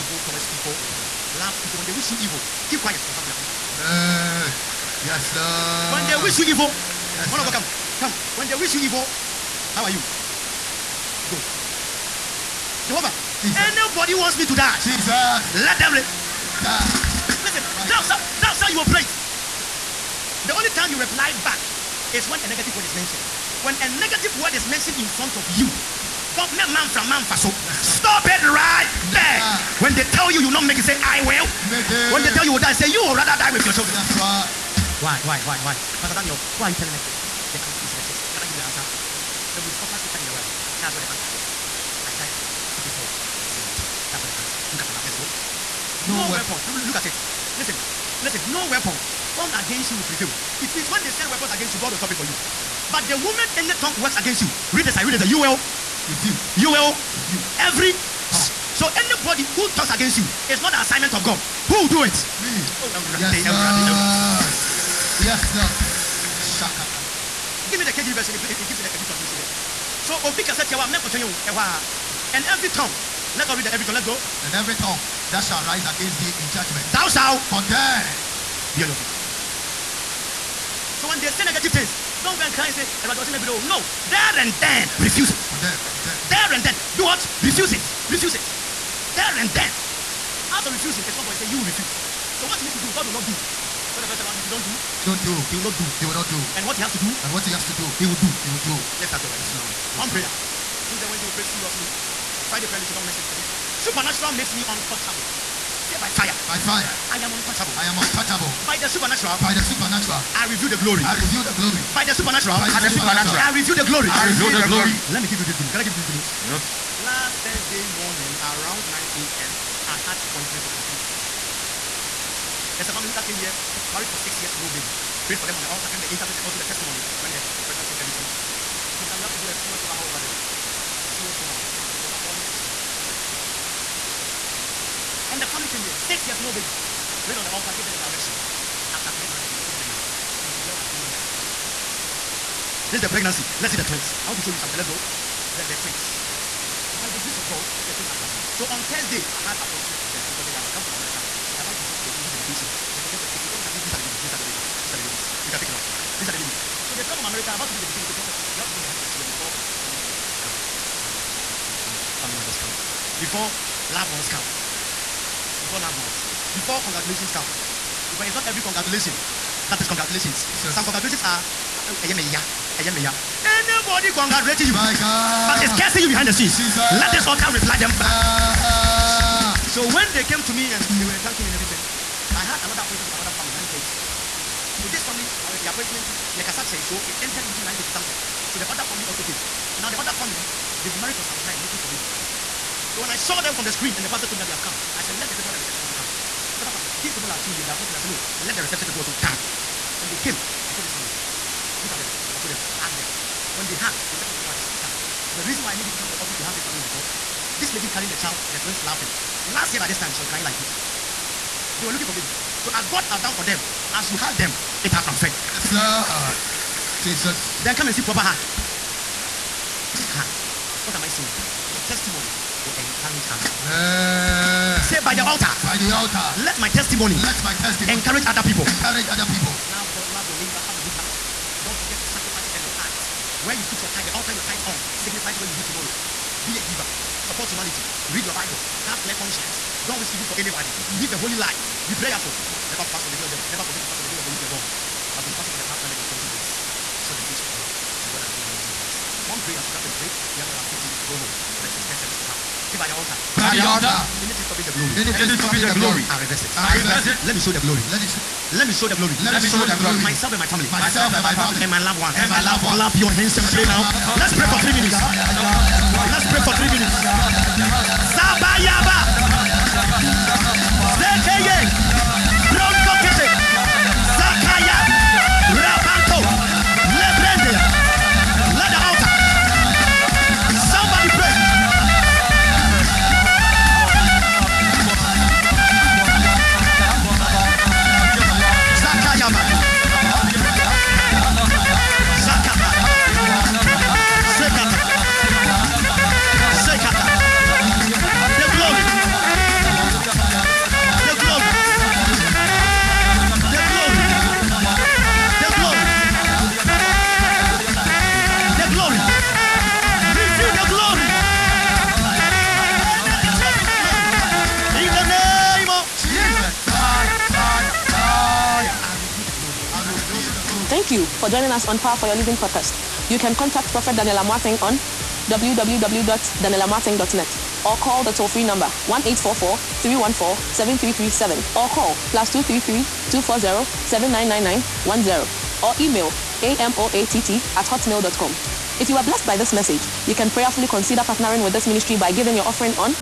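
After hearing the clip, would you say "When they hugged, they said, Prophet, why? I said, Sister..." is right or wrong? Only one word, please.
right.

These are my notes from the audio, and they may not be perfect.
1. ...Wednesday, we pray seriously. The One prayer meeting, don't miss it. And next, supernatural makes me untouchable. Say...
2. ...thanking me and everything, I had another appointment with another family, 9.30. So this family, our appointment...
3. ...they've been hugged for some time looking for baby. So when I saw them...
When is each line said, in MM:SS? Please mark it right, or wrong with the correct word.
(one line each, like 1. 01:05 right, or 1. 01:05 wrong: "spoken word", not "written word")
1. 01:41 wrong: "Friday", not "One"
2. 03:01 right
3. 03:10 wrong: "married", not "hugged".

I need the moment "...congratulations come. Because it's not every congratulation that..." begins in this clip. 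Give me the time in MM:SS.
02:46.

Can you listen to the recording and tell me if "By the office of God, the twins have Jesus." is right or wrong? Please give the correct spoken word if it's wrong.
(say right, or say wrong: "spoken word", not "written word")
wrong: "grace", not "office".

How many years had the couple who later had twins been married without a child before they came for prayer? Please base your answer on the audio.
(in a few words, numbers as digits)
6.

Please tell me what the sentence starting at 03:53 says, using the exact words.
Where you put your tithe, the altar your tithe on signifies where you'll be tomorrow.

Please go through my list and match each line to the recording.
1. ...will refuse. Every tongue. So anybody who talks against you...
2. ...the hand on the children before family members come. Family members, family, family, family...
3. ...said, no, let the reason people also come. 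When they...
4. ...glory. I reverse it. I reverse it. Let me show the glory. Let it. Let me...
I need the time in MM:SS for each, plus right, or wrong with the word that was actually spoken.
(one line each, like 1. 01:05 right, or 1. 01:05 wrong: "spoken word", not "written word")
1. 00:56 right
2. 02:38 right
3. 03:17 wrong: "reception", not "reason"
4. 04:15 right.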